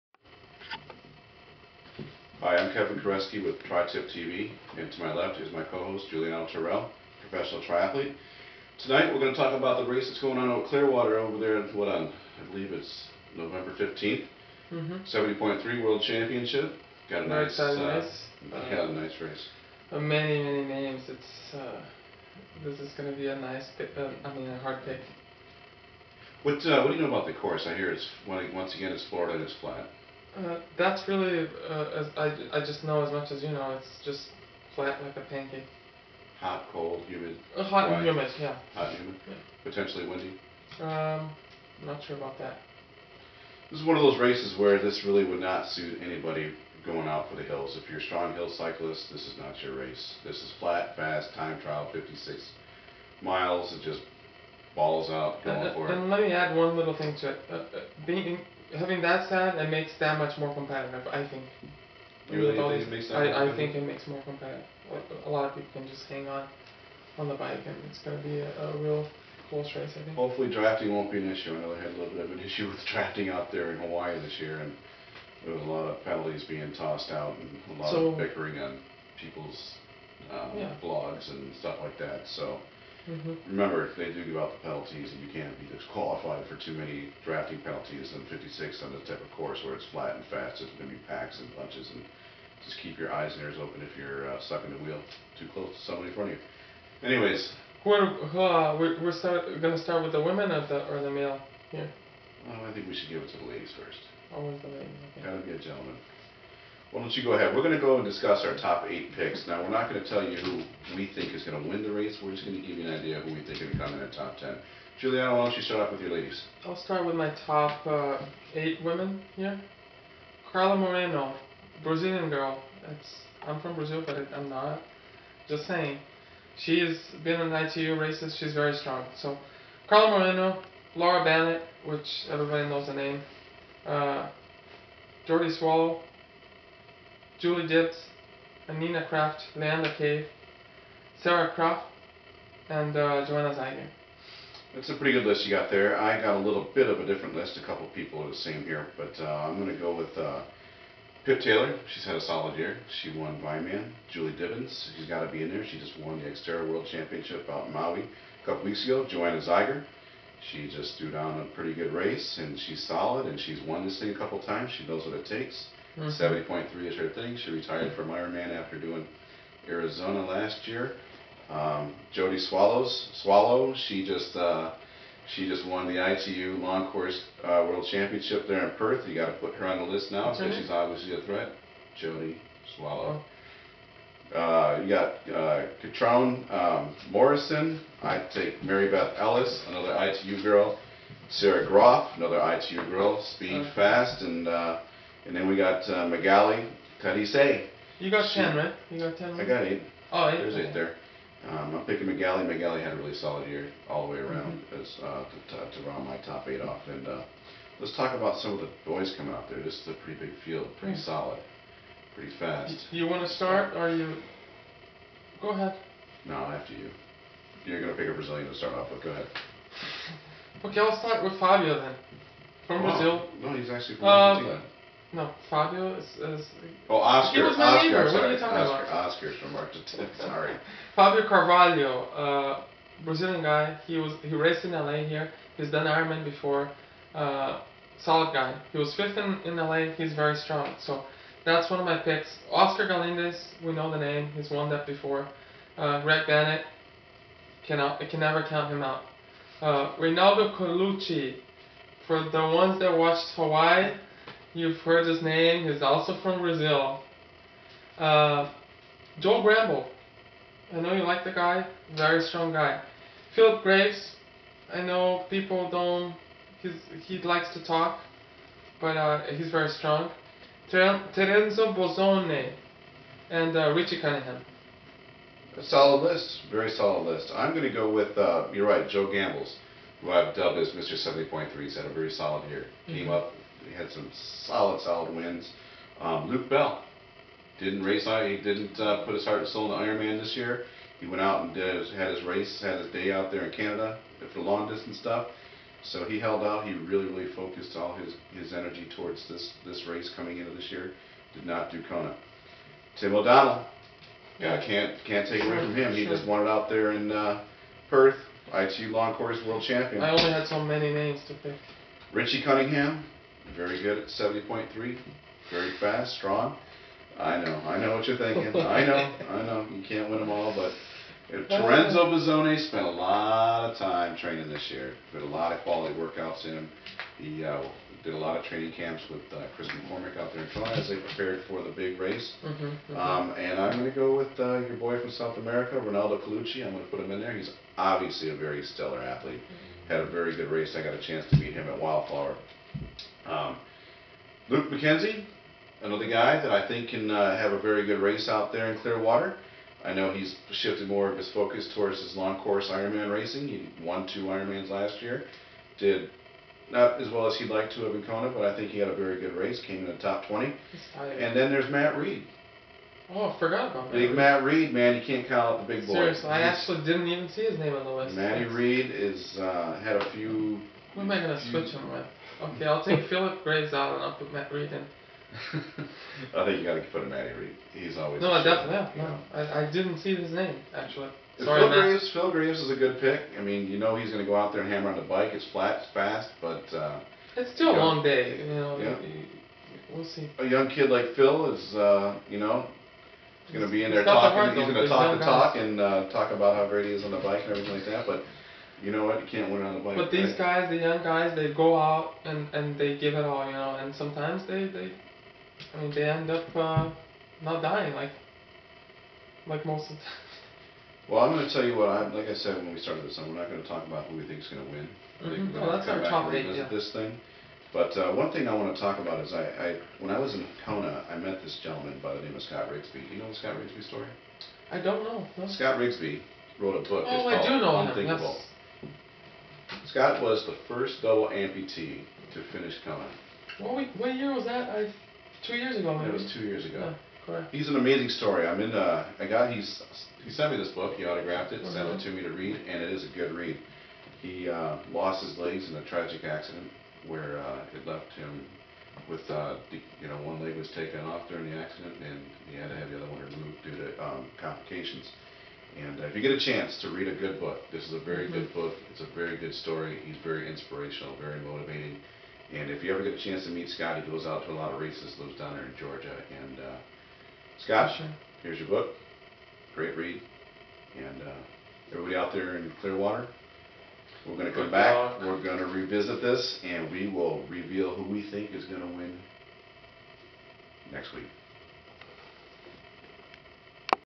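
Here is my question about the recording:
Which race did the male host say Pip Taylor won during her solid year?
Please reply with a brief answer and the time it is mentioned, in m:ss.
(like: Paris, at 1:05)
Vineman, at 2:33.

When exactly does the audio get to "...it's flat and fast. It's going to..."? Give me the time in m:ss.
1:29.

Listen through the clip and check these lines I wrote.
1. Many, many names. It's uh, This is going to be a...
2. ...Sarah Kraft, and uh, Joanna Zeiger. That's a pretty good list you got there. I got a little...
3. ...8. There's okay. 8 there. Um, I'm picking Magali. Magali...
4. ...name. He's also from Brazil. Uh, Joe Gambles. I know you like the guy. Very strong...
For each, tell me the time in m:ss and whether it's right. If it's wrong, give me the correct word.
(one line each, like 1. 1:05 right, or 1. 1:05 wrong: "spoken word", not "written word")
1. 0:19 right
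2. 2:21 right
3. 3:20 right
4. 4:15 right.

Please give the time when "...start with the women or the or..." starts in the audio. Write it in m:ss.
1:39.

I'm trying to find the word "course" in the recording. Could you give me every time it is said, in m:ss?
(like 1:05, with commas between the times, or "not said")
0:27, 1:29, 2:56, 5:09, 5:52.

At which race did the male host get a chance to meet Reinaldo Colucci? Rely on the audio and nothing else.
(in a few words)
Wildflower.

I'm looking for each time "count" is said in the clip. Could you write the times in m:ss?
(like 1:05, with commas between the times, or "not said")
4:08, 6:05.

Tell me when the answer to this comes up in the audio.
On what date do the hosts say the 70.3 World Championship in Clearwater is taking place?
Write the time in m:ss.
0:13.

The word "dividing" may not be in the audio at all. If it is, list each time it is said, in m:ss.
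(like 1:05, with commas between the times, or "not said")
not said.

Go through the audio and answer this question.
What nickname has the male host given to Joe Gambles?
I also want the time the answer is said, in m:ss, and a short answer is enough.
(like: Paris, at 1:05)
Mr. 70.3, at 4:40.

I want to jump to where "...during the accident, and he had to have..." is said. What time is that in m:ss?
7:31.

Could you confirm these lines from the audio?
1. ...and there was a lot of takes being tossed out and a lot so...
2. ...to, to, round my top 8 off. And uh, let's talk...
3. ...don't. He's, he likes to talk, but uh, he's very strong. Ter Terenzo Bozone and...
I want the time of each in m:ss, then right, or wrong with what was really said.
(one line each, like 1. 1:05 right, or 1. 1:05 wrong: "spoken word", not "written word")
1. 1:14 wrong: "penalties", not "takes"
2. 3:25 right
3. 4:25 right.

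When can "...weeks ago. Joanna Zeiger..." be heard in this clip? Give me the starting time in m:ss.
2:38.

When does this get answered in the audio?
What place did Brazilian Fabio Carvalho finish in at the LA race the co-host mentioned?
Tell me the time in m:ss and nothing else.
3:58.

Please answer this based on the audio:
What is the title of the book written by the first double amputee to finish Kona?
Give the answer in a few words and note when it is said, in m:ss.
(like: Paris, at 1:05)
Unthinkable, at 7:07.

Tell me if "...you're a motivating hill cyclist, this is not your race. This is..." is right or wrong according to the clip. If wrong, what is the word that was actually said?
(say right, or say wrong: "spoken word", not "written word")
wrong: "strong", not "motivating".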